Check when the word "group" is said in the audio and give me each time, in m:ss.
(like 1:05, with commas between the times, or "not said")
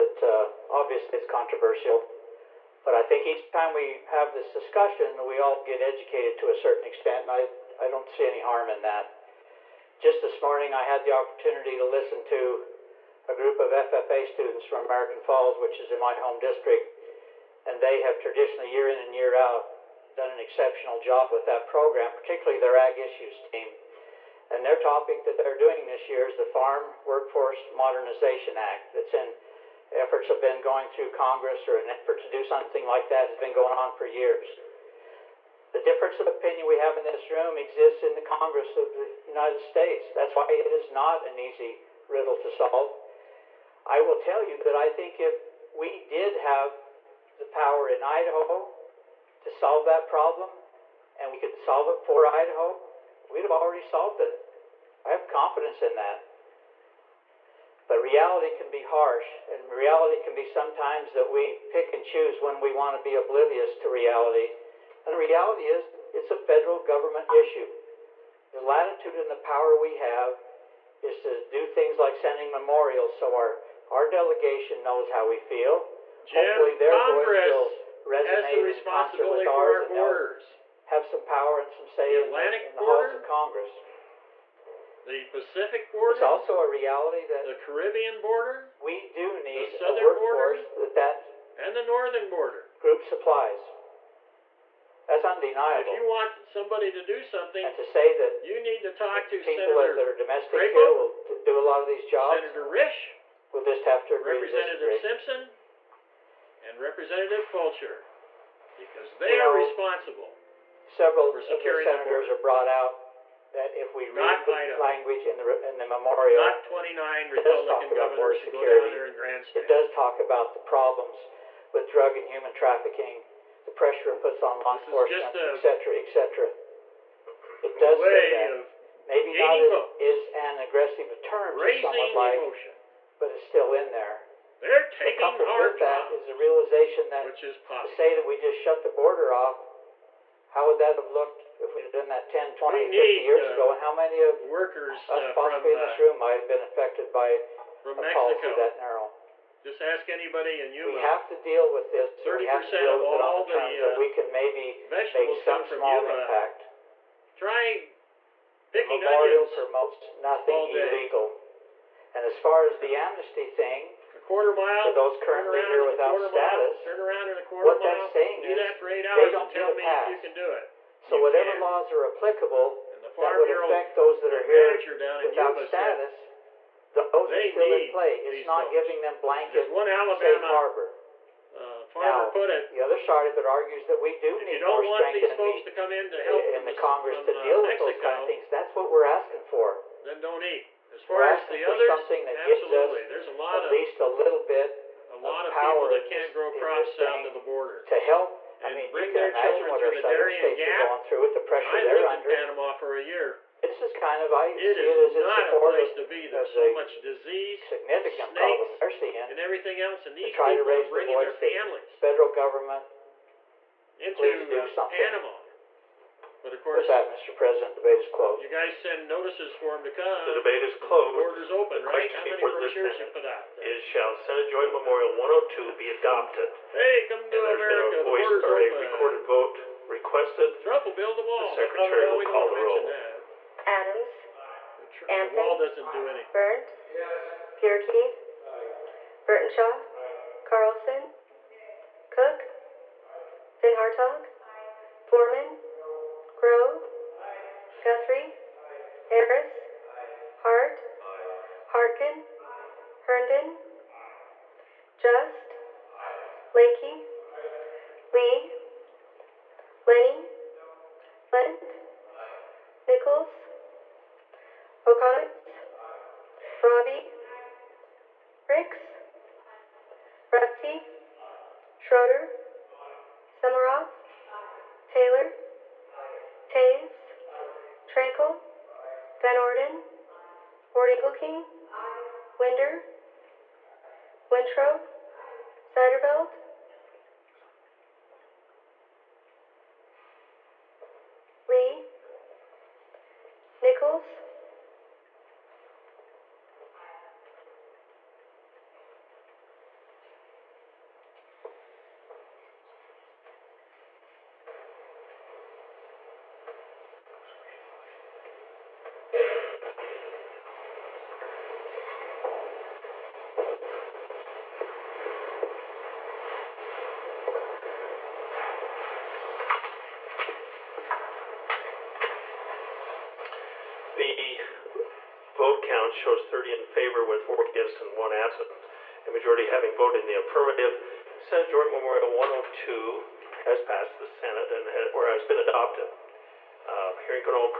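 0:13, 1:32.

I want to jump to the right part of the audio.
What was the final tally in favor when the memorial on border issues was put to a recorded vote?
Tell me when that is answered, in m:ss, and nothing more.
5:26.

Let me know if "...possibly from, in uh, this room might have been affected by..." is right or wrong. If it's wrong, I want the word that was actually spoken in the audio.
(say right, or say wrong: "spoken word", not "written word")
right.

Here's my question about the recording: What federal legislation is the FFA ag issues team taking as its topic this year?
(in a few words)
Farm Workforce Modernization Act.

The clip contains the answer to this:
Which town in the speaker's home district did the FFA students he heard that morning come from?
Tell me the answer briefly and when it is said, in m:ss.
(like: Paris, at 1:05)
American Falls, at 0:14.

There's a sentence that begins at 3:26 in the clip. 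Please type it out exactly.
There's so much disease, snakes, and everything else, and these people are bringing the their families.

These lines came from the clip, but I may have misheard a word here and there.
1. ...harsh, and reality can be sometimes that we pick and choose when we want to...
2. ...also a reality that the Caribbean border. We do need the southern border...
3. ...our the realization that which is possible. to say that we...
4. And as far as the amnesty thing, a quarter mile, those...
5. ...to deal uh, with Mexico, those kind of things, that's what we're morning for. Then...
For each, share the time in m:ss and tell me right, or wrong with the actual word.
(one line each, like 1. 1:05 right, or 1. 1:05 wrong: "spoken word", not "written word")
1. 0:58 right
2. 1:26 right
3. 2:15 right
4. 2:42 right
5. 3:07 wrong: "asking", not "morning".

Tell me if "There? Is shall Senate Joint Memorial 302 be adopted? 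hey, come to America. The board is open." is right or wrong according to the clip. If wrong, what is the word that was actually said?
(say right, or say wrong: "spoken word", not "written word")
wrong: "102", not "302".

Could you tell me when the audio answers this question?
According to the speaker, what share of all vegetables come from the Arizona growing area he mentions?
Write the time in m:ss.
2:32.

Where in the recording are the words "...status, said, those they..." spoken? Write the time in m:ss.
2:55.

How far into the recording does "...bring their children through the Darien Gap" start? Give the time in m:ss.
3:18.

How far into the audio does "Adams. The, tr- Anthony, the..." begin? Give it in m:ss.
3:53.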